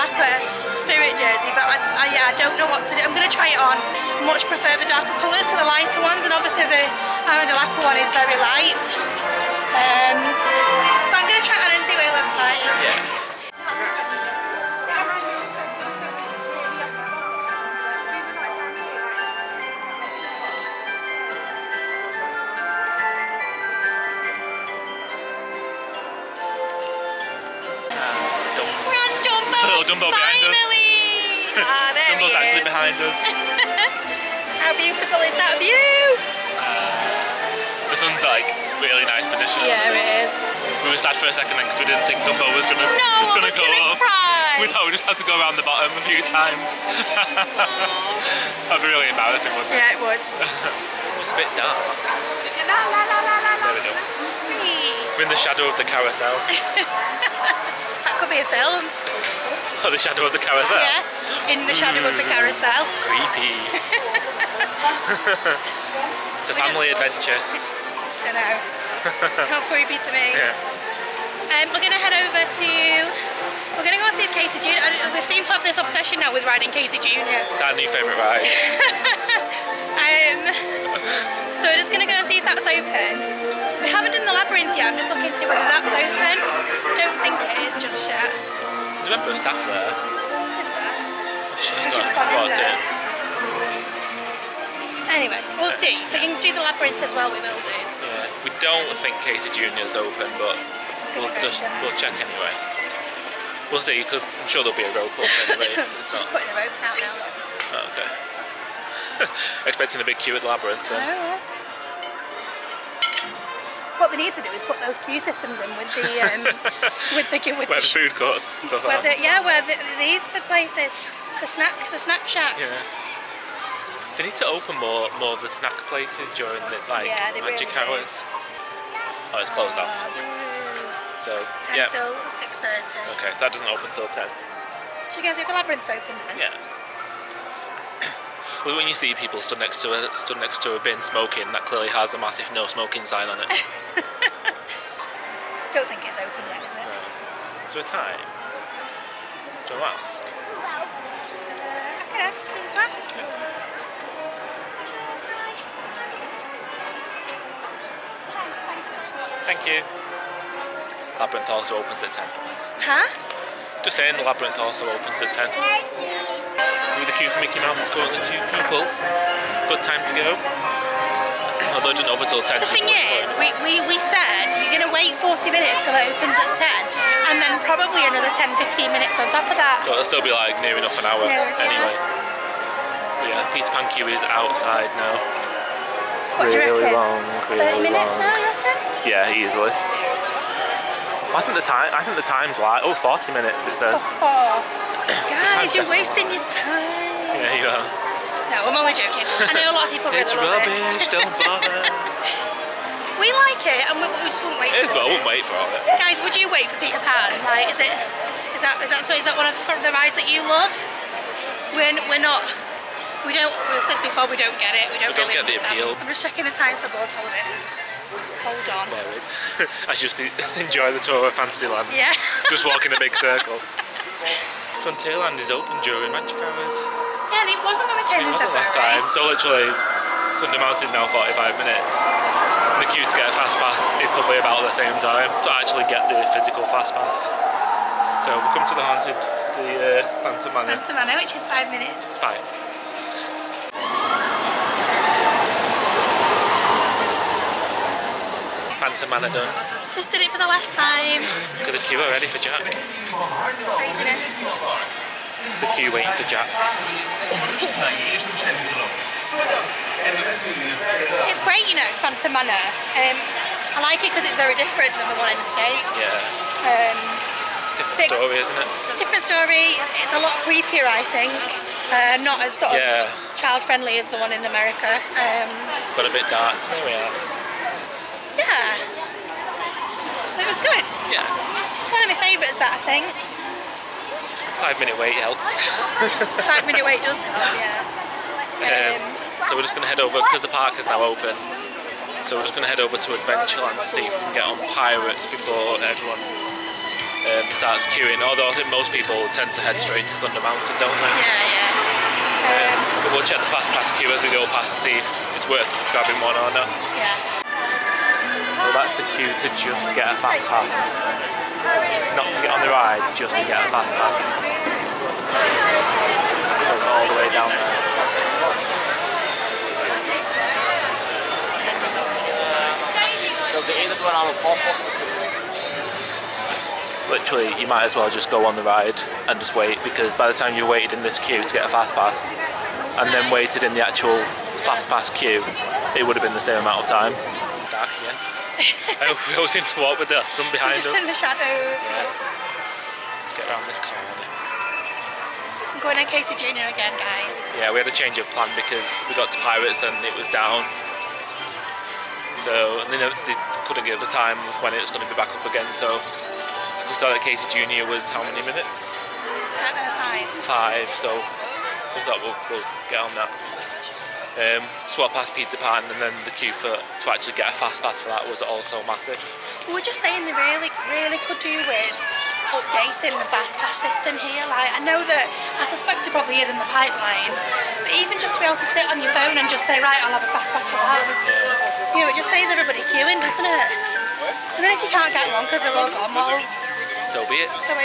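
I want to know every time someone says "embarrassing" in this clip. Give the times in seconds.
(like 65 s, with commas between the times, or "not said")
49 s.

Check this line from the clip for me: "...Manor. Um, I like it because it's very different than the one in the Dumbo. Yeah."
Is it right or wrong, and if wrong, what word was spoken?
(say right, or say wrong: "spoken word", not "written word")
wrong: "States", not "Dumbo".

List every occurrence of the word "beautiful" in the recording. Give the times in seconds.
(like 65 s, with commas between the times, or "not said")
34 s.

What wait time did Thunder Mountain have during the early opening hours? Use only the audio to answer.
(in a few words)
45 minutes.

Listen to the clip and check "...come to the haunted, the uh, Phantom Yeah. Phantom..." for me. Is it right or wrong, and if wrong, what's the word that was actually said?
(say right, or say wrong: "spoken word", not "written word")
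wrong: "Manor", not "Yeah".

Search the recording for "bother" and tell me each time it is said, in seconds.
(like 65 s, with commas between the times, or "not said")
201 s.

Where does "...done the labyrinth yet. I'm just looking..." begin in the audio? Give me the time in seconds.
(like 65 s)
84 s.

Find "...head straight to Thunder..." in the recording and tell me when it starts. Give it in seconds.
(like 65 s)
299 s.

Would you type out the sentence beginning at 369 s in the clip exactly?
We were just saying they really, really could do with updating the fast pass system here.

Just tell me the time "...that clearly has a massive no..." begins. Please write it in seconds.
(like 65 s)
141 s.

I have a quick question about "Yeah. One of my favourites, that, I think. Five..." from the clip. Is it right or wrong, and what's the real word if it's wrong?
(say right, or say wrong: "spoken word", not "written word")
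right.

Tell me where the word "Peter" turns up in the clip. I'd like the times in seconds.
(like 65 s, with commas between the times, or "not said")
183 s, 206 s, 365 s.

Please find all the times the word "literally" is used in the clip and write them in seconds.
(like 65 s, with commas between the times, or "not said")
229 s, 327 s.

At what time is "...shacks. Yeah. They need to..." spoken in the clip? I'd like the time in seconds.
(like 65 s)
122 s.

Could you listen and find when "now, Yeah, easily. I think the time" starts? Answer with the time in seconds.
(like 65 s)
188 s.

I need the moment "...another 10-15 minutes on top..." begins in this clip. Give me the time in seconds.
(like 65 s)
178 s.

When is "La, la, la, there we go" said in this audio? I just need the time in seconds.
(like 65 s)
52 s.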